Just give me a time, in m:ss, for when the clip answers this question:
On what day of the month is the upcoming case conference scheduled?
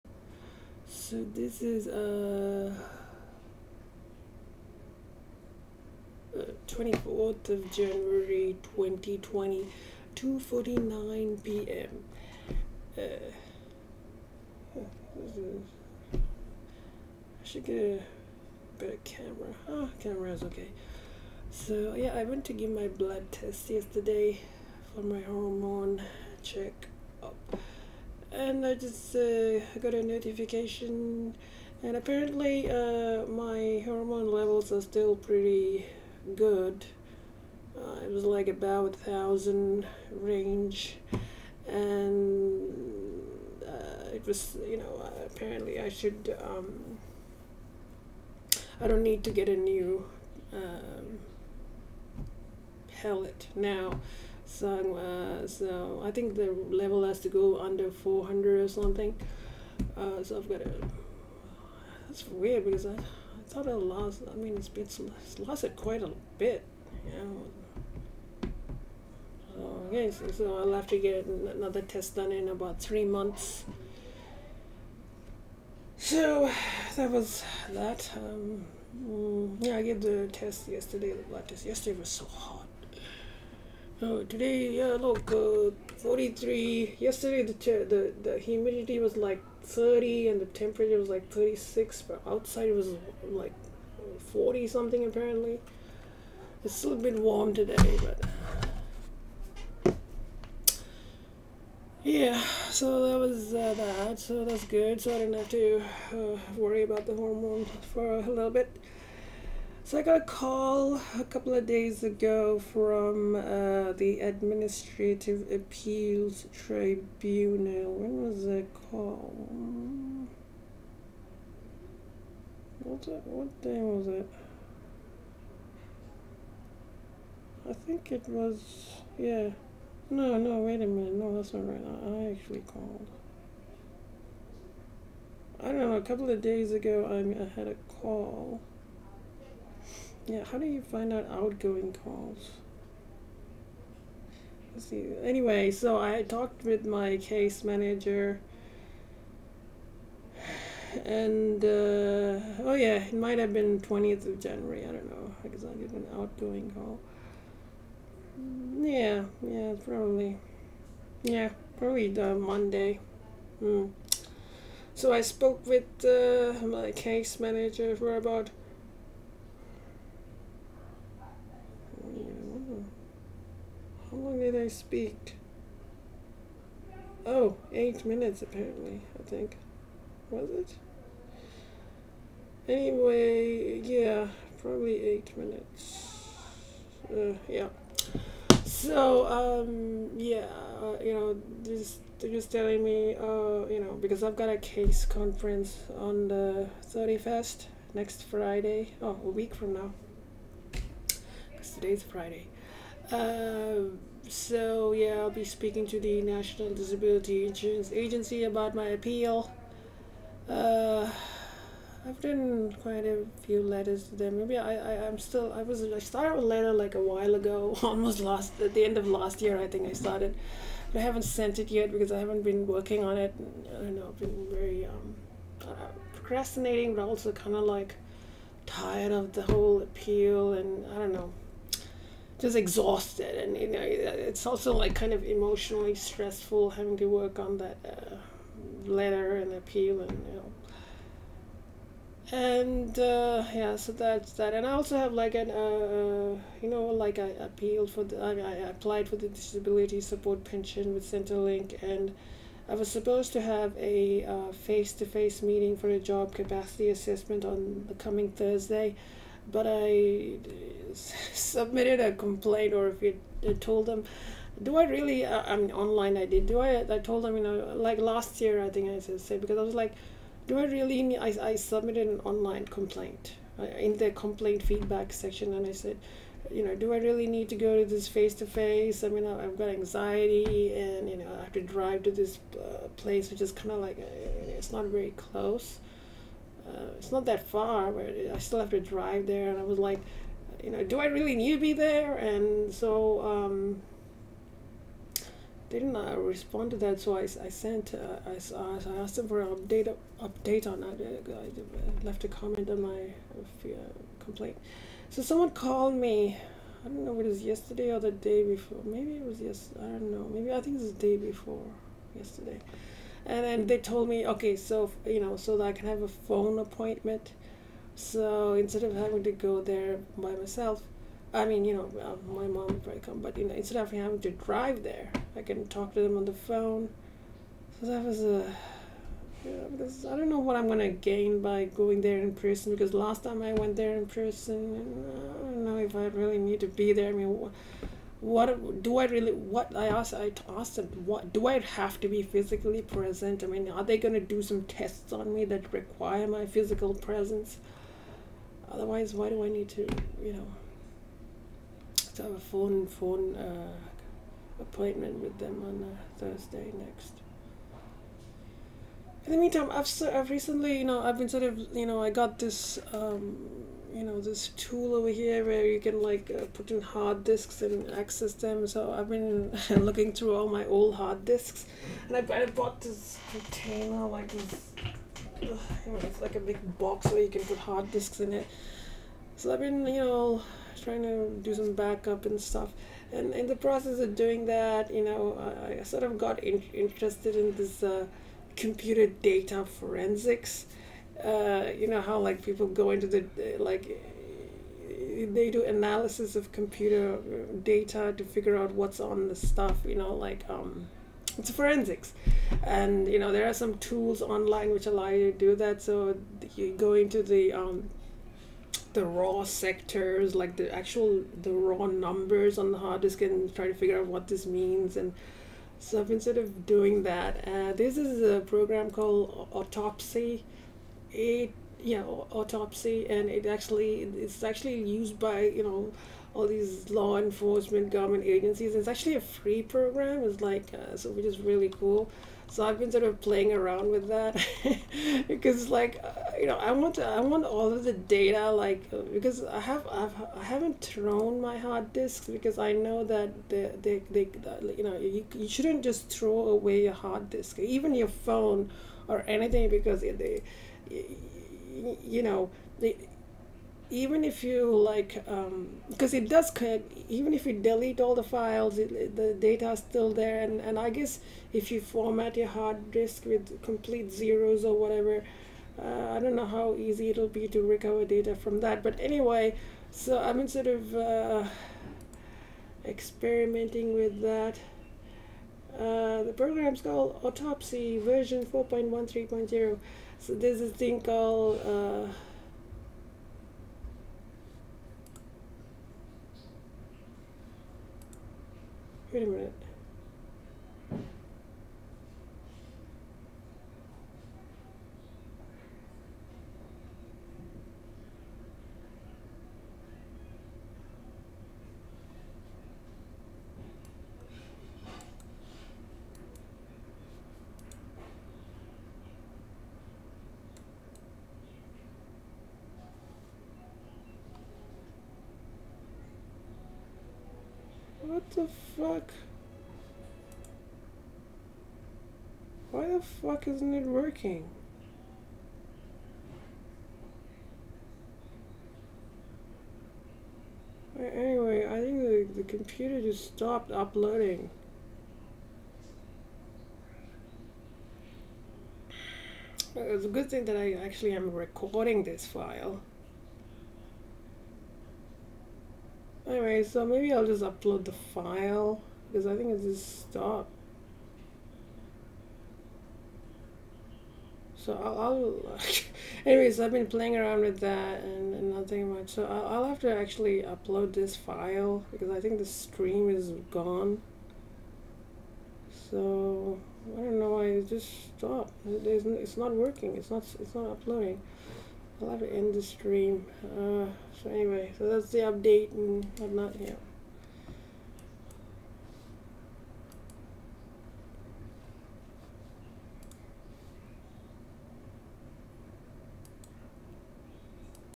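3:16.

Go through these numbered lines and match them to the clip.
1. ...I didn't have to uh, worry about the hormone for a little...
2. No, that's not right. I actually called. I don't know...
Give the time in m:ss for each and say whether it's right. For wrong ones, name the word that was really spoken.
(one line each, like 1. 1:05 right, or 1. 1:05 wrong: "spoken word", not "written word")
1. 1:45 right
2. 2:11 right.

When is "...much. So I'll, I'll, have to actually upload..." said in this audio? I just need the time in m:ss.
9:18.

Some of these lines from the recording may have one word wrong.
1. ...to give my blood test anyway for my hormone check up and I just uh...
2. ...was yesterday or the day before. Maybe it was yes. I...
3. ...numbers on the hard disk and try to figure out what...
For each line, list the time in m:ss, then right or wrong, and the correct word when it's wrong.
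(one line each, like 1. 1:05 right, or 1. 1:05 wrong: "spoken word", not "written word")
1. 0:22 wrong: "yesterday", not "anyway"
2. 5:07 right
3. 6:51 right.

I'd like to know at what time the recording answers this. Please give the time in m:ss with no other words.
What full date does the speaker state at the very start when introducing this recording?
0:06.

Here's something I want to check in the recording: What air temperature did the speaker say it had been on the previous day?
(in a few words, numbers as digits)
36.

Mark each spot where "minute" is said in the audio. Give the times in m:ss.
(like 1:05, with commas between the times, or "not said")
2:10, 2:58, 3:05, 8:09.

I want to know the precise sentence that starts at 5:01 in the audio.
I left a comment on my uh, complaint.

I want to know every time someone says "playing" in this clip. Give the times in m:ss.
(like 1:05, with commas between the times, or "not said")
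7:13, 9:16.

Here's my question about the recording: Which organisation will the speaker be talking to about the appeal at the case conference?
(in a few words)
National Disability Insurance Agency.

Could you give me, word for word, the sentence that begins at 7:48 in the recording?
But anyway, so I'm sort of uh, experimenting with that.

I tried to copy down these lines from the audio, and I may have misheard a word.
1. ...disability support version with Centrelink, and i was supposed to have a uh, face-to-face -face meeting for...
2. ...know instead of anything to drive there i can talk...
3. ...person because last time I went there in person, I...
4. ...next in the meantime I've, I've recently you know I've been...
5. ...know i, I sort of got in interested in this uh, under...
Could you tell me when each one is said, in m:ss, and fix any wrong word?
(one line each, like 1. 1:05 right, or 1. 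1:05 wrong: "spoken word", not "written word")
1. 4:09 wrong: "pension", not "version"
2. 5:23 wrong: "having", not "anything"
3. 5:32 right
4. 5:56 right
5. 6:25 wrong: "computer", not "under".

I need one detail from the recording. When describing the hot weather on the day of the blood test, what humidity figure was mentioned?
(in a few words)
30.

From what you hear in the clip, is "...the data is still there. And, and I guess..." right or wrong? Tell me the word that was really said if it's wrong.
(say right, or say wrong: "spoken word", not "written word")
right.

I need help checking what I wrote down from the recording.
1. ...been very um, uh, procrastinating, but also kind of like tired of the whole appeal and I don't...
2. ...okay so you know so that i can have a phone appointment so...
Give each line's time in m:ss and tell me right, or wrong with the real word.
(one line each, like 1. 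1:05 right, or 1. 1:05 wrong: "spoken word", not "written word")
1. 3:44 right
2. 5:14 right.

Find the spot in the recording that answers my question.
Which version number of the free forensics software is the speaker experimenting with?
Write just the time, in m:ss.
7:58.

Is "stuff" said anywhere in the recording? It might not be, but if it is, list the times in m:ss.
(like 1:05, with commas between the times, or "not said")
6:22, 6:39, 6:55.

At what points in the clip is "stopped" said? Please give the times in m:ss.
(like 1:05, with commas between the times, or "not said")
8:53, 9:10, 9:28.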